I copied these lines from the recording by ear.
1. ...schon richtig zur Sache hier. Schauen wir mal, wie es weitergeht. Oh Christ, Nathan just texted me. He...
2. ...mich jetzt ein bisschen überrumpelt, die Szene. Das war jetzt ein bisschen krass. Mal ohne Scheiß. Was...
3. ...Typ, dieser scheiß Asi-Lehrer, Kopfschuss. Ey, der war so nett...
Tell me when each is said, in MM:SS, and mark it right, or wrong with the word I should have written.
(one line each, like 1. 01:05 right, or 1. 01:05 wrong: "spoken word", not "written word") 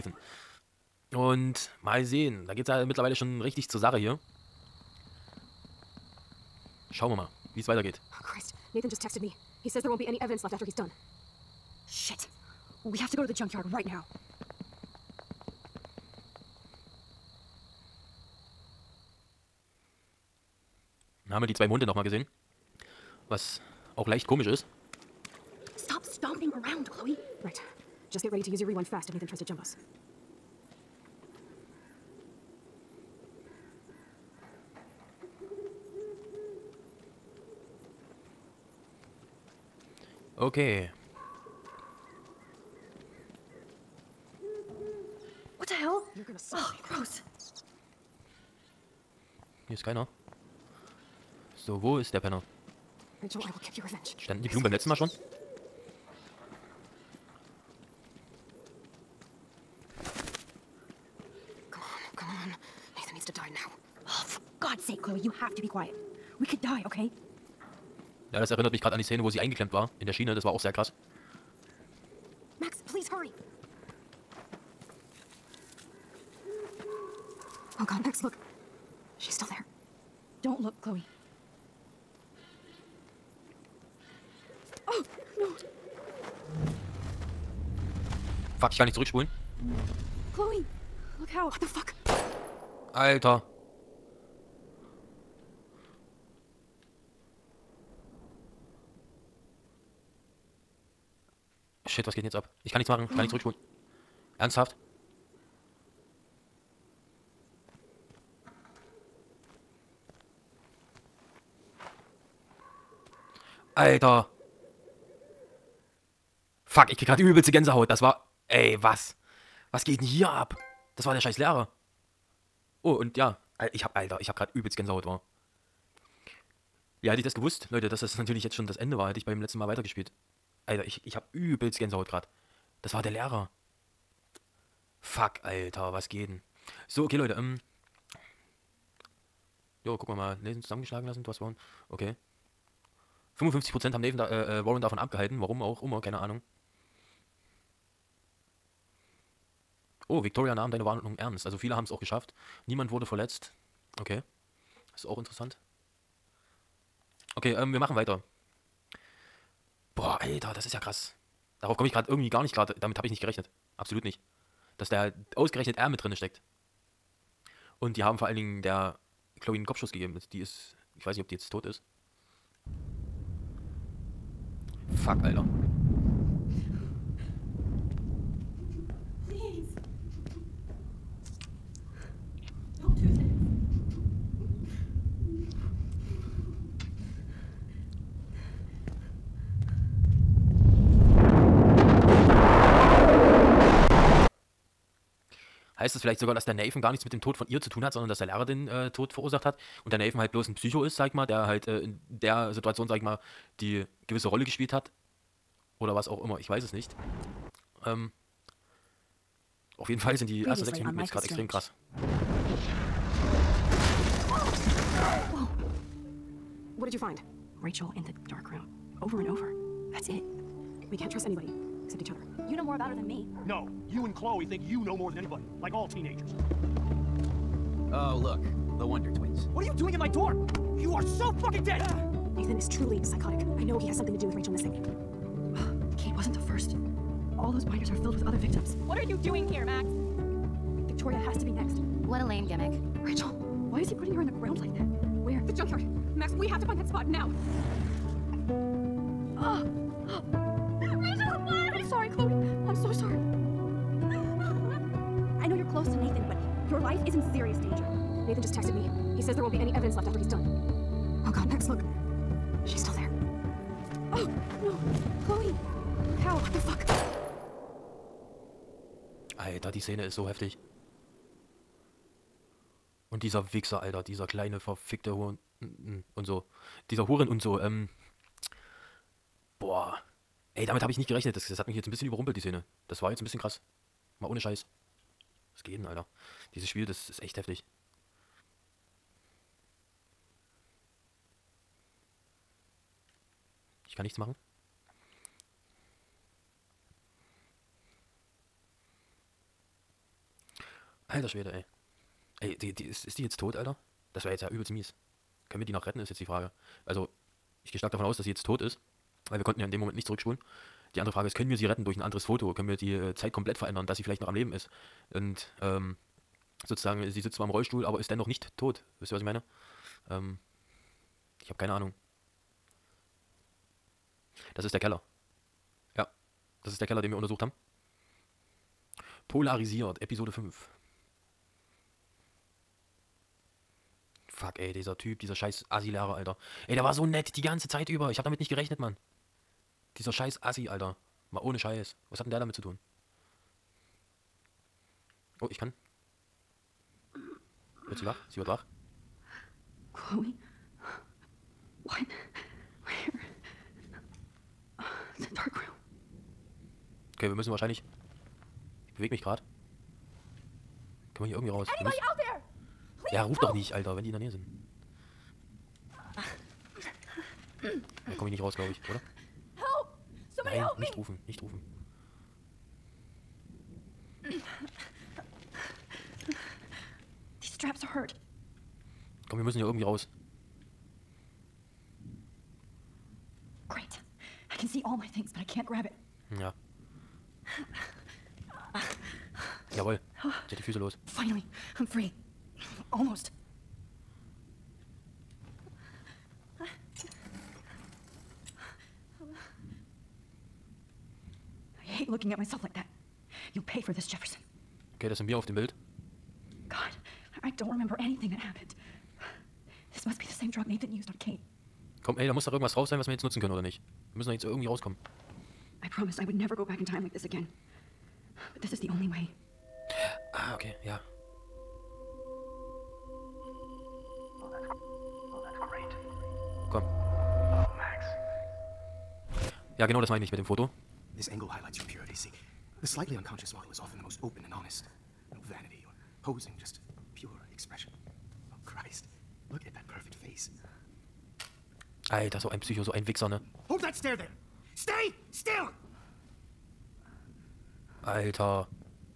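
1. 00:03 right
2. 04:41 right
3. 05:34 wrong: "Alter", not "Kopfschuss".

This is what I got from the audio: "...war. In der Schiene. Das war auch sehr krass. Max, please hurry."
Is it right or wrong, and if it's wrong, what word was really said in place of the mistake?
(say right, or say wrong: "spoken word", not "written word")
right.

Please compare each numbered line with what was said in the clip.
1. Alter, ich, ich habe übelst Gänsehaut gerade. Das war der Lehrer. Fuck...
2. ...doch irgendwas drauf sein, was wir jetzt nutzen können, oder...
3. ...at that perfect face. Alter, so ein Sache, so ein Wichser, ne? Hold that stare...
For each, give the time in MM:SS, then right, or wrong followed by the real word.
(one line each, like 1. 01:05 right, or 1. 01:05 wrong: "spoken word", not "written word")
1. 02:10 right
2. 06:52 right
3. 07:19 wrong: "Psycho", not "Sache".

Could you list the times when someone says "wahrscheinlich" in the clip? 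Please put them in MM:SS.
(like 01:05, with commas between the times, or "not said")
05:57.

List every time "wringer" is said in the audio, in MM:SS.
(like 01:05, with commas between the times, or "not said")
not said.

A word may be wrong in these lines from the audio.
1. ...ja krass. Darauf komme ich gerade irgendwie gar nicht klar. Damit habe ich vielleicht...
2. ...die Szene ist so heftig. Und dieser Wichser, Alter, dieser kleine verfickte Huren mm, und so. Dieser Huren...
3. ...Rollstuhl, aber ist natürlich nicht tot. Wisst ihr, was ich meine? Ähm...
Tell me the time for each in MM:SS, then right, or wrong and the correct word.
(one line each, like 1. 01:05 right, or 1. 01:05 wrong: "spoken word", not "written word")
1. 02:40 wrong: "nicht", not "vielleicht"
2. 04:29 right
3. 05:17 wrong: "dennoch", not "natürlich".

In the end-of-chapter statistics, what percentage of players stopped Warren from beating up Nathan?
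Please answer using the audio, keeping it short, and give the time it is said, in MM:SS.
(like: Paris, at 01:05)
55%, at 02:23.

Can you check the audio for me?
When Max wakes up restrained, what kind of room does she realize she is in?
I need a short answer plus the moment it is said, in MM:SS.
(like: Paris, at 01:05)
a dark room, at 05:55.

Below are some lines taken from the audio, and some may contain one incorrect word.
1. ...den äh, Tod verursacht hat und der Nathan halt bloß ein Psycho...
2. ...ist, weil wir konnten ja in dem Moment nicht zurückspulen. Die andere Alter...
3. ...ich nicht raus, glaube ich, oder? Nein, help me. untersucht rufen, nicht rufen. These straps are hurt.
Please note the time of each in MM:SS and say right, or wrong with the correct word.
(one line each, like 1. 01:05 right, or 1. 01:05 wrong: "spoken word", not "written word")
1. 03:18 right
2. 05:08 wrong: "Frage", not "Alter"
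3. 06:08 wrong: "nicht", not "untersucht".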